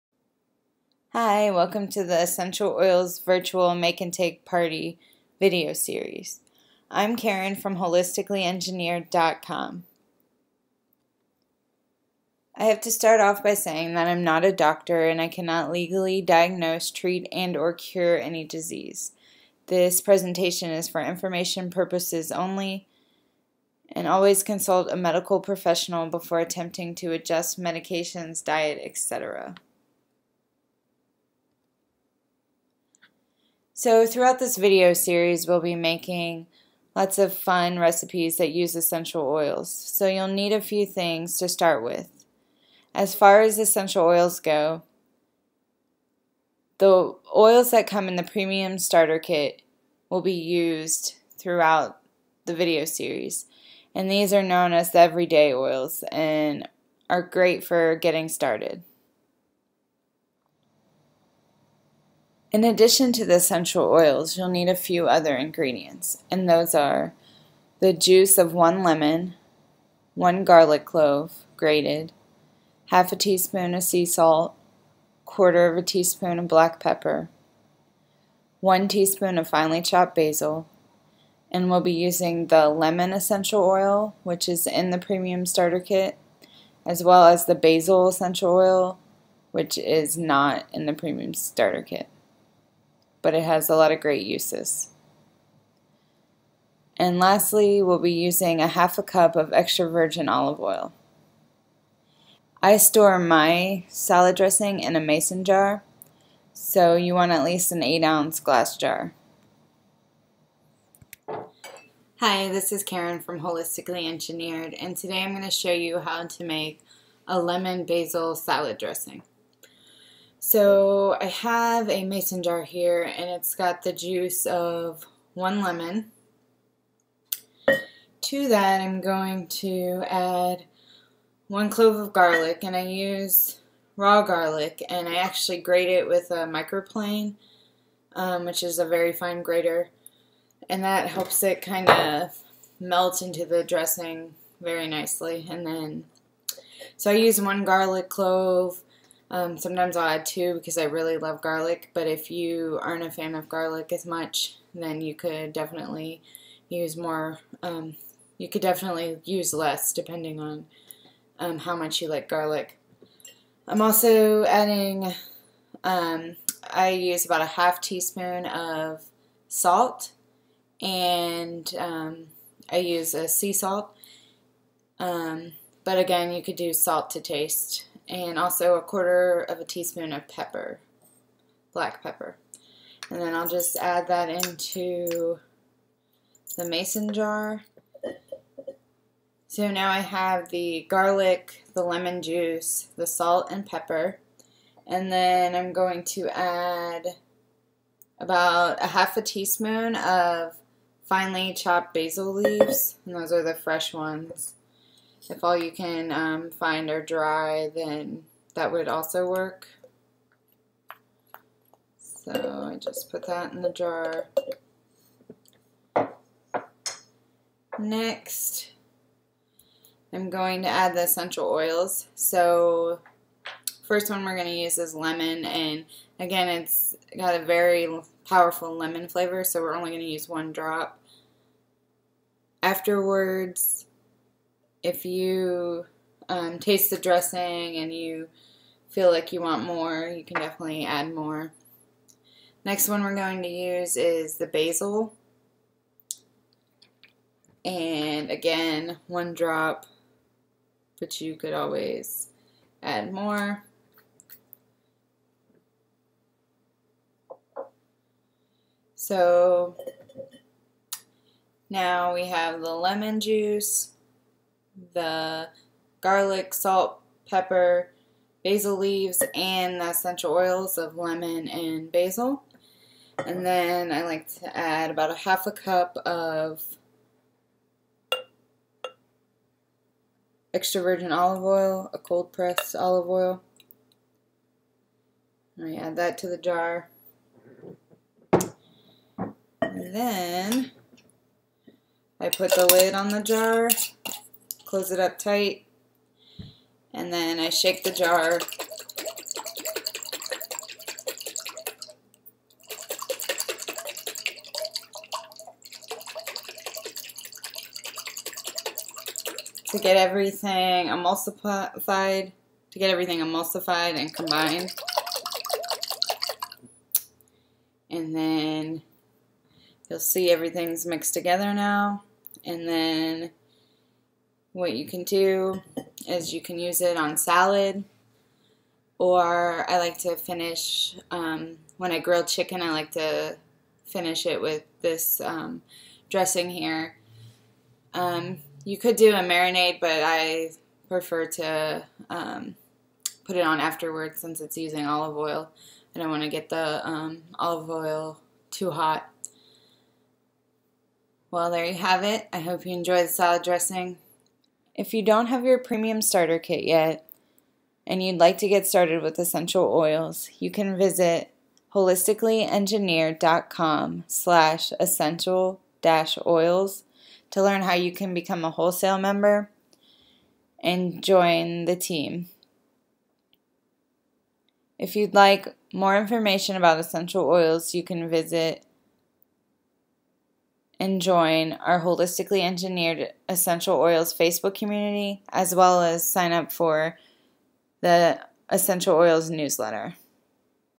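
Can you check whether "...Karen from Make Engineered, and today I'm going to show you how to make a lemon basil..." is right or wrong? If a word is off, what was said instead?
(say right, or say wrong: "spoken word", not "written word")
wrong: "Holistically", not "Make".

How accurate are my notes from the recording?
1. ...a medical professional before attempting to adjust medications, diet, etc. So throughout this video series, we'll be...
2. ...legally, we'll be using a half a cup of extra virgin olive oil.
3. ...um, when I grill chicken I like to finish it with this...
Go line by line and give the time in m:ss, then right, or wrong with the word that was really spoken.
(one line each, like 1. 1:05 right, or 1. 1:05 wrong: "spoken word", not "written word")
1. 0:24 right
2. 1:37 wrong: "lastly", not "legally"
3. 5:31 right.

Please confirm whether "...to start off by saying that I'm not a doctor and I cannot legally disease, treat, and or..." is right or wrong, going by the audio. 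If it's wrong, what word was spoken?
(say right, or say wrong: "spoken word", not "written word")
wrong: "diagnose", not "disease".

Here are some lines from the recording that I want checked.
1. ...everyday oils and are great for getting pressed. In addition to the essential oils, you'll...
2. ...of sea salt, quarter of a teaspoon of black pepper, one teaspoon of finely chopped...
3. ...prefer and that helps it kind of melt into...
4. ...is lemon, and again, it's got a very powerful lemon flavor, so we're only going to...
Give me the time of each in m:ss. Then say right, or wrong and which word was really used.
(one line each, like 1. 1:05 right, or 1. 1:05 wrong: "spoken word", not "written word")
1. 0:54 wrong: "started", not "pressed"
2. 1:13 right
3. 2:19 wrong: "grater", not "prefer"
4. 3:44 right.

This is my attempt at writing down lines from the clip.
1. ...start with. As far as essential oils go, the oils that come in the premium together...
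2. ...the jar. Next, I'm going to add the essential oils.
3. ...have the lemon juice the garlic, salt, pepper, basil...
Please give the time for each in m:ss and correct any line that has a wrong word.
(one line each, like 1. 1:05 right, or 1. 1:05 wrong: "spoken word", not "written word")
1. 0:41 wrong: "starter", not "together"
2. 3:33 right
3. 4:22 right.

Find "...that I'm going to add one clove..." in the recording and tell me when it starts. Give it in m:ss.
2:08.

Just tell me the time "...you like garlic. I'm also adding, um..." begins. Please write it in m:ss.
2:42.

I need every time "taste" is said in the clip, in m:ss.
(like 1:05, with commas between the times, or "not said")
2:57, 3:56.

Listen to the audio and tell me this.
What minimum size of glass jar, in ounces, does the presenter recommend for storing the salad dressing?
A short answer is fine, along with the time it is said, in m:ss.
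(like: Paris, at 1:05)
8 ounce, at 1:47.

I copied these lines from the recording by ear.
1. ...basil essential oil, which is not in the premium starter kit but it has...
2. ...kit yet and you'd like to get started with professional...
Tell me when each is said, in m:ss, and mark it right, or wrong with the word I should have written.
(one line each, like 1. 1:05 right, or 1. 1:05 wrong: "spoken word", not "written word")
1. 1:27 right
2. 5:56 wrong: "essential", not "professional".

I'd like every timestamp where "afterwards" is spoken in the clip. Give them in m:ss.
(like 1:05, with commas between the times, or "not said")
3:52, 5:43.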